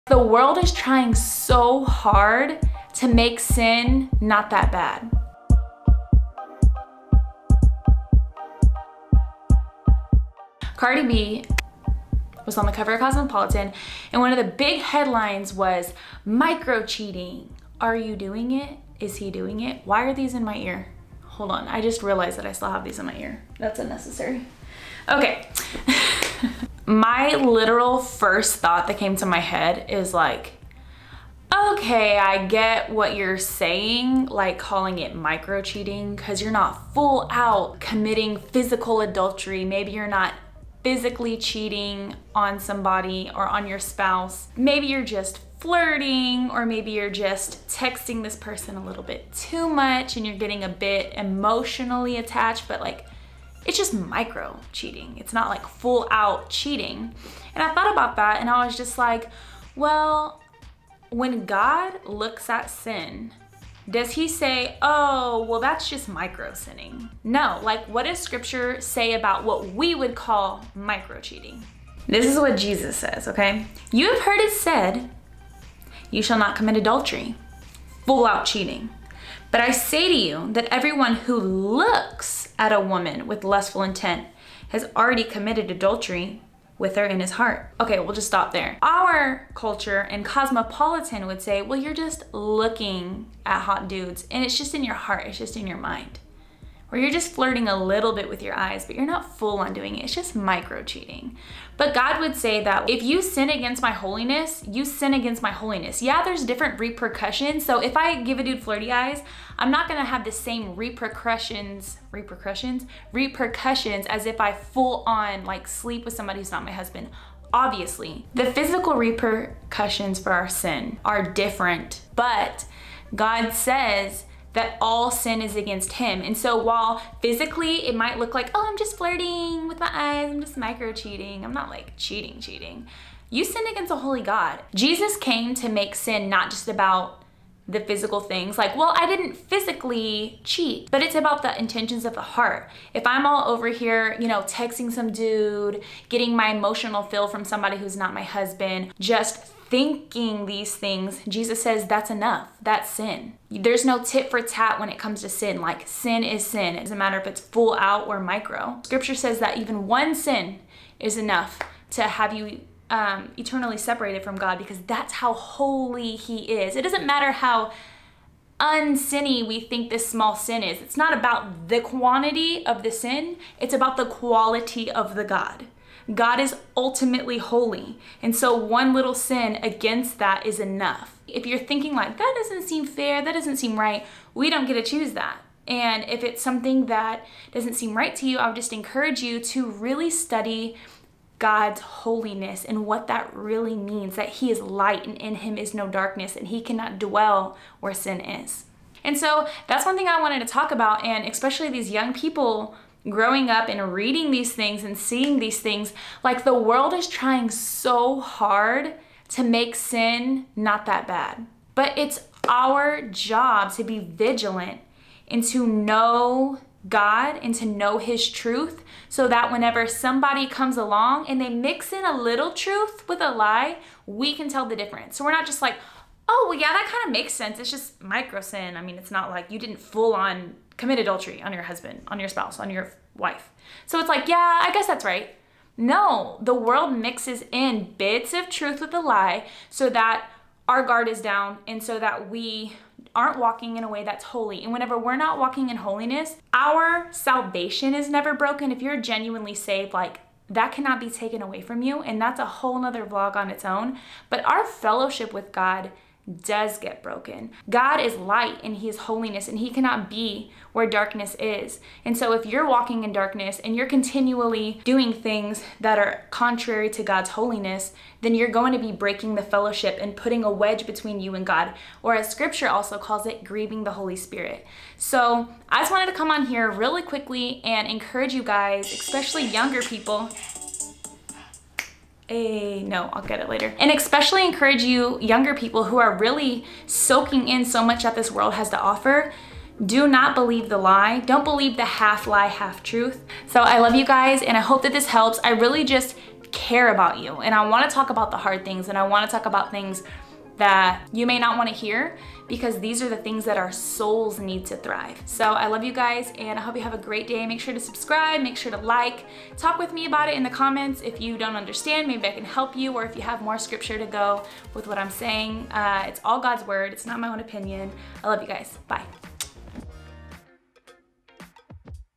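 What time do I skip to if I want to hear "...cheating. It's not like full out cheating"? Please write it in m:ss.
0:54.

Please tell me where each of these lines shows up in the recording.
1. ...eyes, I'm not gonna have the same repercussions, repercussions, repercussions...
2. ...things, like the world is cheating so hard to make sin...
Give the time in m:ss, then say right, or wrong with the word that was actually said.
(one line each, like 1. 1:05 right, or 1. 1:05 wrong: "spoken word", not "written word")
1. 1:48 right
2. 3:25 wrong: "trying", not "cheating".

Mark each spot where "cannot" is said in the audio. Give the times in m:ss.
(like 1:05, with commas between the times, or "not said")
3:16, 4:10, 4:19.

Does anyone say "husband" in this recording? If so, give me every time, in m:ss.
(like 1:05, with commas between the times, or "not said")
1:56, 2:28, 3:51.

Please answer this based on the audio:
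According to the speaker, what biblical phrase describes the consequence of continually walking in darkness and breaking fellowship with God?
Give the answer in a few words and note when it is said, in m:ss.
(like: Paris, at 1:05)
grieving the Holy Spirit, at 4:33.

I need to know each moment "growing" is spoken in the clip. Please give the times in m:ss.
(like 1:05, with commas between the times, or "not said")
3:23.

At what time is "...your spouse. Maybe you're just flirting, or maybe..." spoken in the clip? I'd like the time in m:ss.
0:43.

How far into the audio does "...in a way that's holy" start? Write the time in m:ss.
4:03.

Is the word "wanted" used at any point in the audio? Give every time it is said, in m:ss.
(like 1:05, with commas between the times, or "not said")
3:20, 4:35.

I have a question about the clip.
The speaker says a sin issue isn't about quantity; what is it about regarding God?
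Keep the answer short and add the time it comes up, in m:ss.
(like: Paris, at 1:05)
the quality of the God, at 2:53.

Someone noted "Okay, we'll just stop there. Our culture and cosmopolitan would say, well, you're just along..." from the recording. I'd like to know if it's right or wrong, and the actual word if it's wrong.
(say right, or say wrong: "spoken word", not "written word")
wrong: "looking", not "along".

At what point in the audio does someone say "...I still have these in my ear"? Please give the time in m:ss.
0:22.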